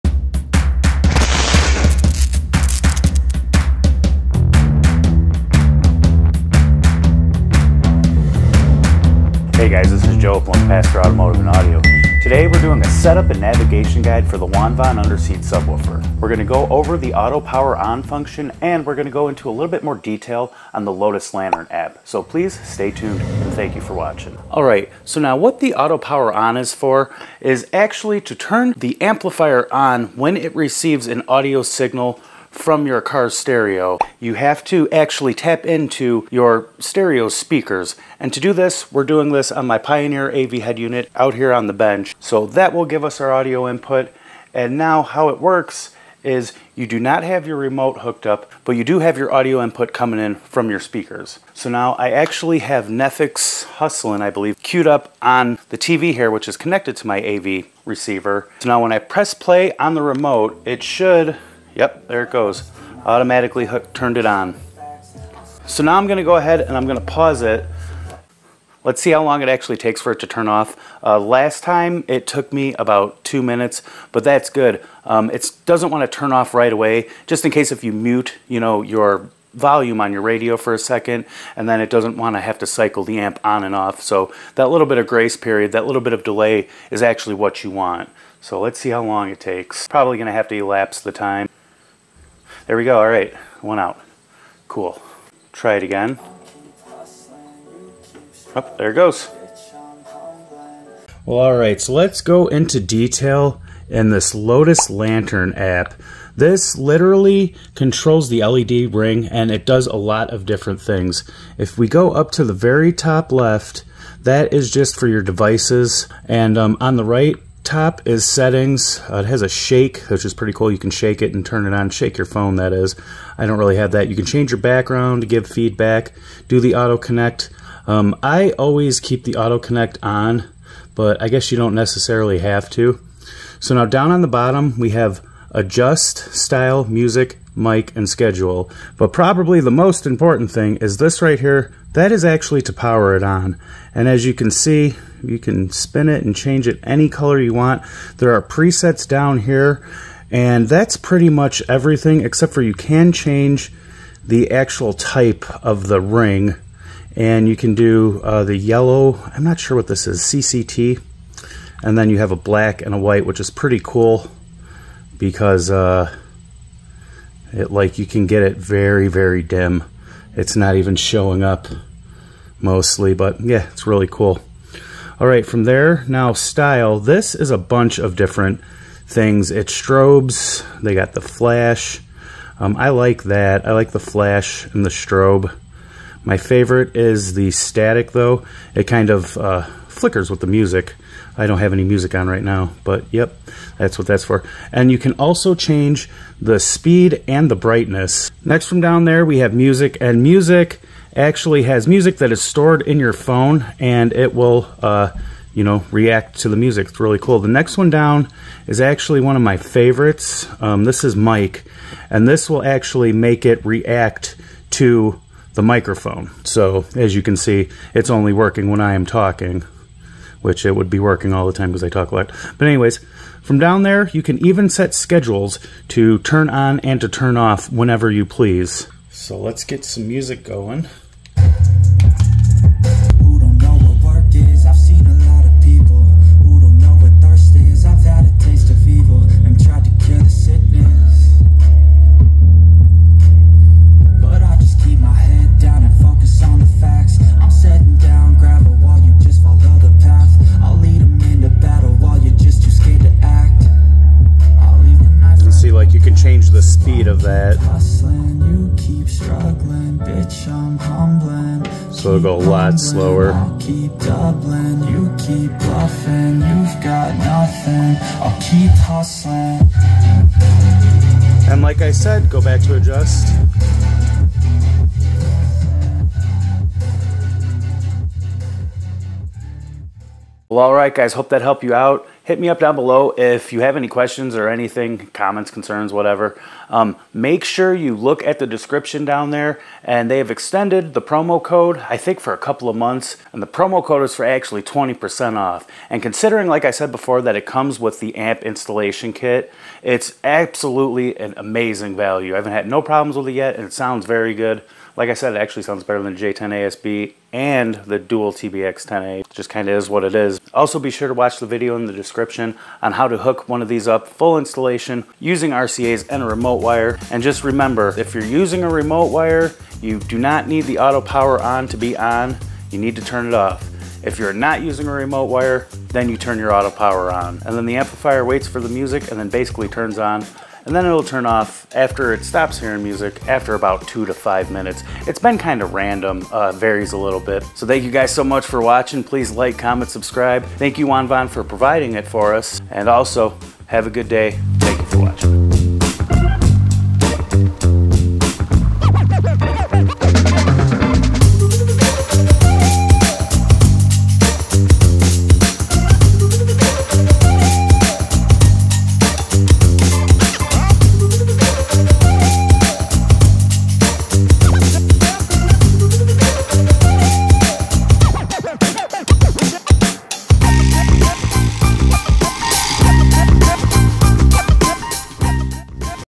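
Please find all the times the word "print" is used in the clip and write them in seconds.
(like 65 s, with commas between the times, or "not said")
not said.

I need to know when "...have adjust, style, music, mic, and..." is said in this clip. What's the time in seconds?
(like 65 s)
134 s.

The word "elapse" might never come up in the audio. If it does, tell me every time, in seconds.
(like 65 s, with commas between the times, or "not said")
90 s.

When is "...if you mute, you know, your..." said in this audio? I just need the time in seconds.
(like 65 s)
77 s.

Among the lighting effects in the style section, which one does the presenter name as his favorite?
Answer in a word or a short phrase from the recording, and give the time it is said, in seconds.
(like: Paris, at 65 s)
Static, at 187 s.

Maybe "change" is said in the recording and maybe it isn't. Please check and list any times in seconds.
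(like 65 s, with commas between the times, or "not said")
124 s, 146 s, 153 s, 195 s.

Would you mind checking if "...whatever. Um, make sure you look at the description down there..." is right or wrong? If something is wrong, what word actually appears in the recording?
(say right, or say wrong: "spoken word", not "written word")
right.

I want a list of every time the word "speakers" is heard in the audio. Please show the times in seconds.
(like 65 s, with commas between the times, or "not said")
37 s, 50 s.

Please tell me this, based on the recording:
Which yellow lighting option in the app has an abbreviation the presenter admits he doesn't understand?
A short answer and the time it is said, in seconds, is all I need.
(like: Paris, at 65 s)
CCT, at 160 s.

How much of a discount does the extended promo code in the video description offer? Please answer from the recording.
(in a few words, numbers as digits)
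20%.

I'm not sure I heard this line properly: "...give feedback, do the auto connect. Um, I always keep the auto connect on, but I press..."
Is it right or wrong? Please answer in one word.
wrong.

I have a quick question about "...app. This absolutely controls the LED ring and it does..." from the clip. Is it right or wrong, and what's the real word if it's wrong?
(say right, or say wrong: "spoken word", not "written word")
wrong: "literally", not "absolutely".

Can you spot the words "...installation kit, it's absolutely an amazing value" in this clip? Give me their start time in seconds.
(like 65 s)
298 s.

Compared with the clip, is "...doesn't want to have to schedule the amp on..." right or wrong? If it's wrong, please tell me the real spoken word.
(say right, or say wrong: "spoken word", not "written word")
wrong: "cycle", not "schedule".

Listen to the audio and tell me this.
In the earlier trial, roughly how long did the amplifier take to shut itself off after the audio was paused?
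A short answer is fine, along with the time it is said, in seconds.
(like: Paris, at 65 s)
2 minutes, at 73 s.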